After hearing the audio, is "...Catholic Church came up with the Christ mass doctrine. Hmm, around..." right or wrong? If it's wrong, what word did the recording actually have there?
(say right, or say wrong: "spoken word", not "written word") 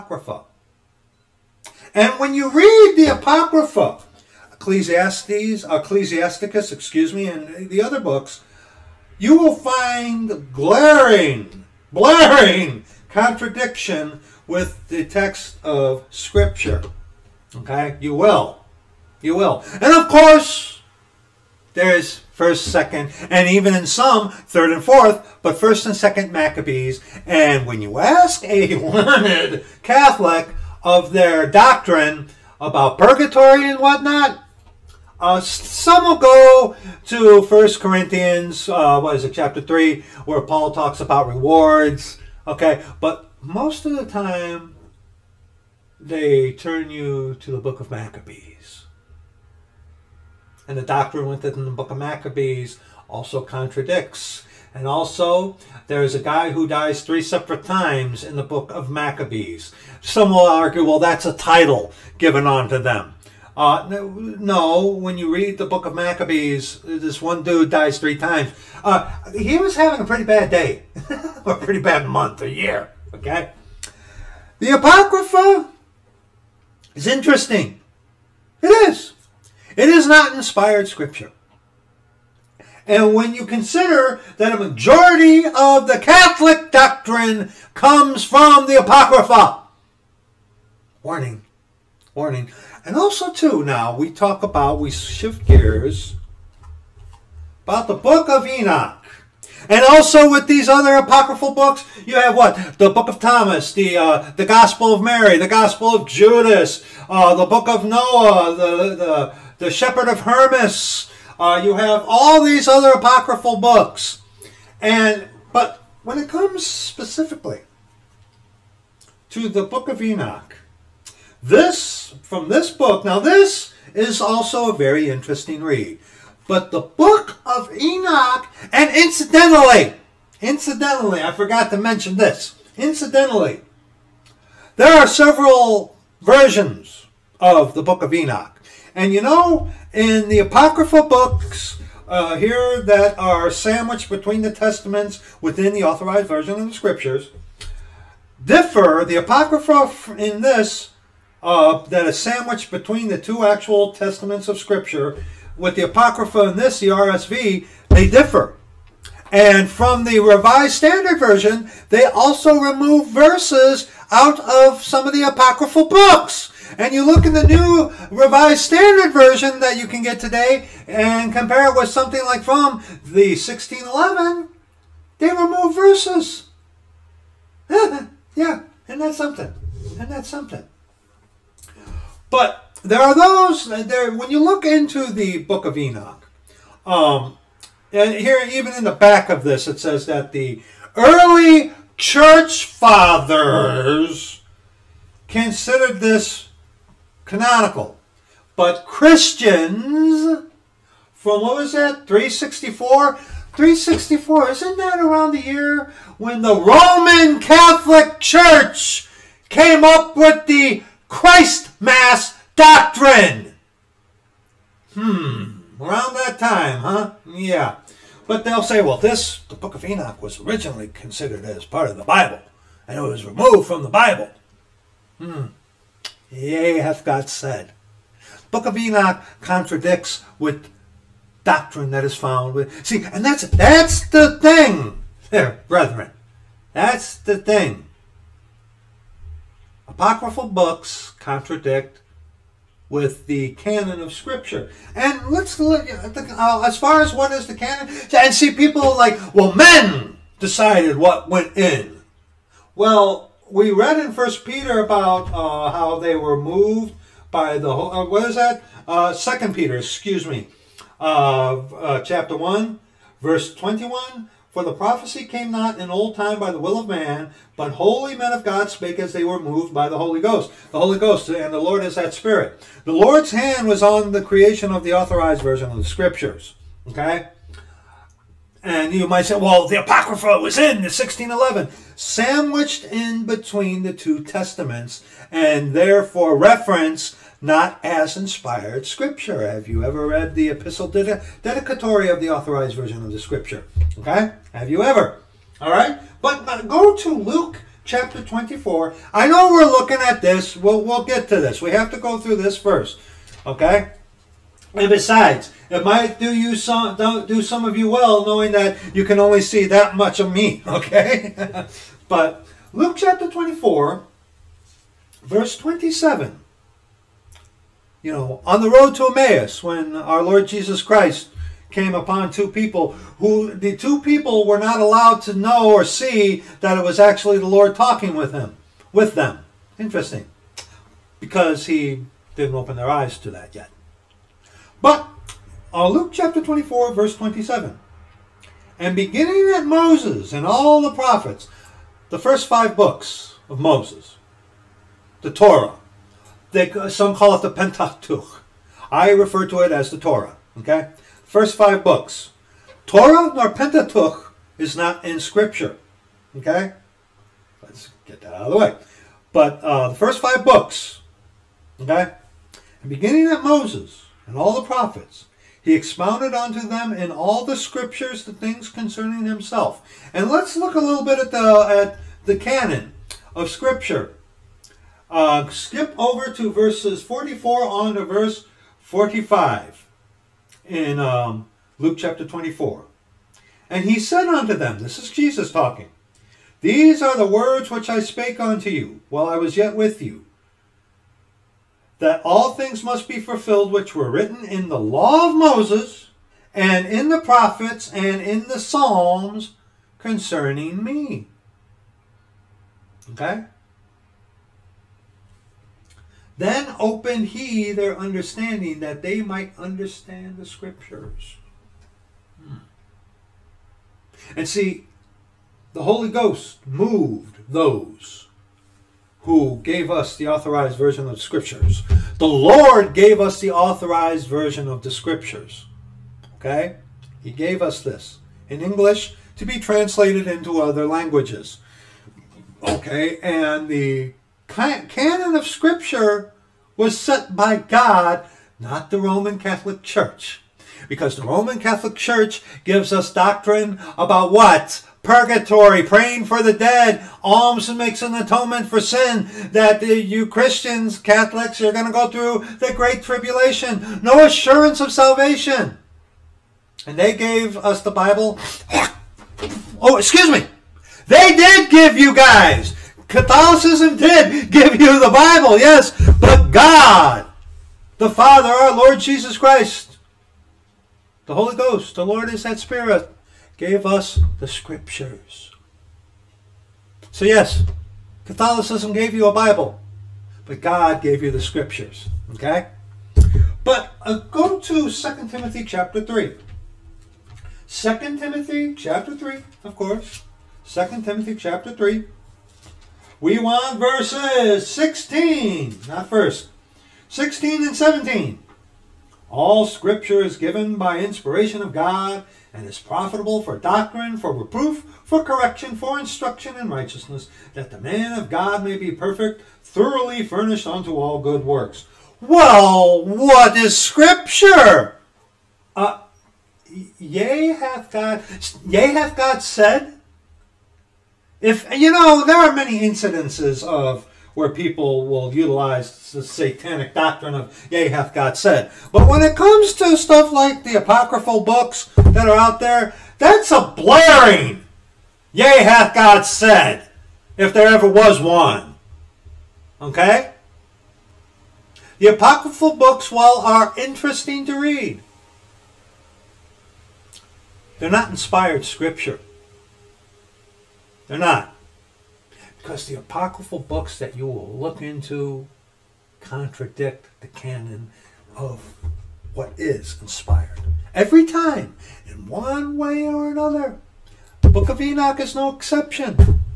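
right.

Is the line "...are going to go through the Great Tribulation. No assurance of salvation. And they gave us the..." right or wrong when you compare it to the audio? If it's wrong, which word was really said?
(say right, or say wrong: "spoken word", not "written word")
right.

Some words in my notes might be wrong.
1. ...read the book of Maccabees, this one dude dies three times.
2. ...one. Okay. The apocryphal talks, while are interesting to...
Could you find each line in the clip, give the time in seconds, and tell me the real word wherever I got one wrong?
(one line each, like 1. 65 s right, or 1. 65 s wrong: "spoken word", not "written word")
1. 65 s right
2. 538 s wrong: "books", not "talks".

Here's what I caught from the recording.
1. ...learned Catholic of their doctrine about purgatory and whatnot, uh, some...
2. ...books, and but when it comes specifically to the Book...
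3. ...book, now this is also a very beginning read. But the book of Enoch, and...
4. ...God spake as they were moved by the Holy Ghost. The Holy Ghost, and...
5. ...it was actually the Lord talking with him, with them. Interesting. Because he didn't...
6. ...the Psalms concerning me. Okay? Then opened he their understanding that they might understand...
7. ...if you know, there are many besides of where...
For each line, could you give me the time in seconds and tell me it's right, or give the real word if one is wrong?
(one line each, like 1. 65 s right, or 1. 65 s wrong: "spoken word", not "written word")
1. 28 s right
2. 113 s right
3. 122 s wrong: "interesting", not "beginning"
4. 268 s right
5. 326 s right
6. 398 s right
7. 521 s wrong: "incidences", not "besides".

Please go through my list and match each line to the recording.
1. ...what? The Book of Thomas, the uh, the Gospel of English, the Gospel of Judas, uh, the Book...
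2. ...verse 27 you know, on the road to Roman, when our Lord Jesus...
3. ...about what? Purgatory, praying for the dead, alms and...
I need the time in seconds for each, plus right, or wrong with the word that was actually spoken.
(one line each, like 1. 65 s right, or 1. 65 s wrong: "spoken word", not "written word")
1. 102 s wrong: "Mary", not "English"
2. 315 s wrong: "Emmaus", not "Roman"
3. 443 s right.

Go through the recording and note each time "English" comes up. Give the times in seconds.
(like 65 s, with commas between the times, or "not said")
428 s.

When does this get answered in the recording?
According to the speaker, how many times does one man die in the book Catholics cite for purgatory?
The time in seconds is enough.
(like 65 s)
57 s.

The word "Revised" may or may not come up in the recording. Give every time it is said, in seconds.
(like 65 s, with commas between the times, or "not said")
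160 s, 168 s.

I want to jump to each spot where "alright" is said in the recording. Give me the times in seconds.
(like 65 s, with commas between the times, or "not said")
not said.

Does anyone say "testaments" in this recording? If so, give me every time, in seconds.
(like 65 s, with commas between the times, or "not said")
144 s, 153 s, 284 s.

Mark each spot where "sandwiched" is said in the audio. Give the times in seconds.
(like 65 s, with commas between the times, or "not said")
143 s, 152 s, 281 s.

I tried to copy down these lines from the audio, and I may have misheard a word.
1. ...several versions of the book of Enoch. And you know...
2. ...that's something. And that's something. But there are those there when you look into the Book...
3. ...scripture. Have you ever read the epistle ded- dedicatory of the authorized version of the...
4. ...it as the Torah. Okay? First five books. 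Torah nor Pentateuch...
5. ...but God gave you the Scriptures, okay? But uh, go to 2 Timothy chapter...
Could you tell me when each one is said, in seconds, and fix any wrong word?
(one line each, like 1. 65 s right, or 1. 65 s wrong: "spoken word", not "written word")
1. 135 s right
2. 179 s right
3. 288 s right
4. 349 s right
5. 480 s right.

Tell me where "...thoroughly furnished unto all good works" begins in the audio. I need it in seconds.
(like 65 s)
509 s.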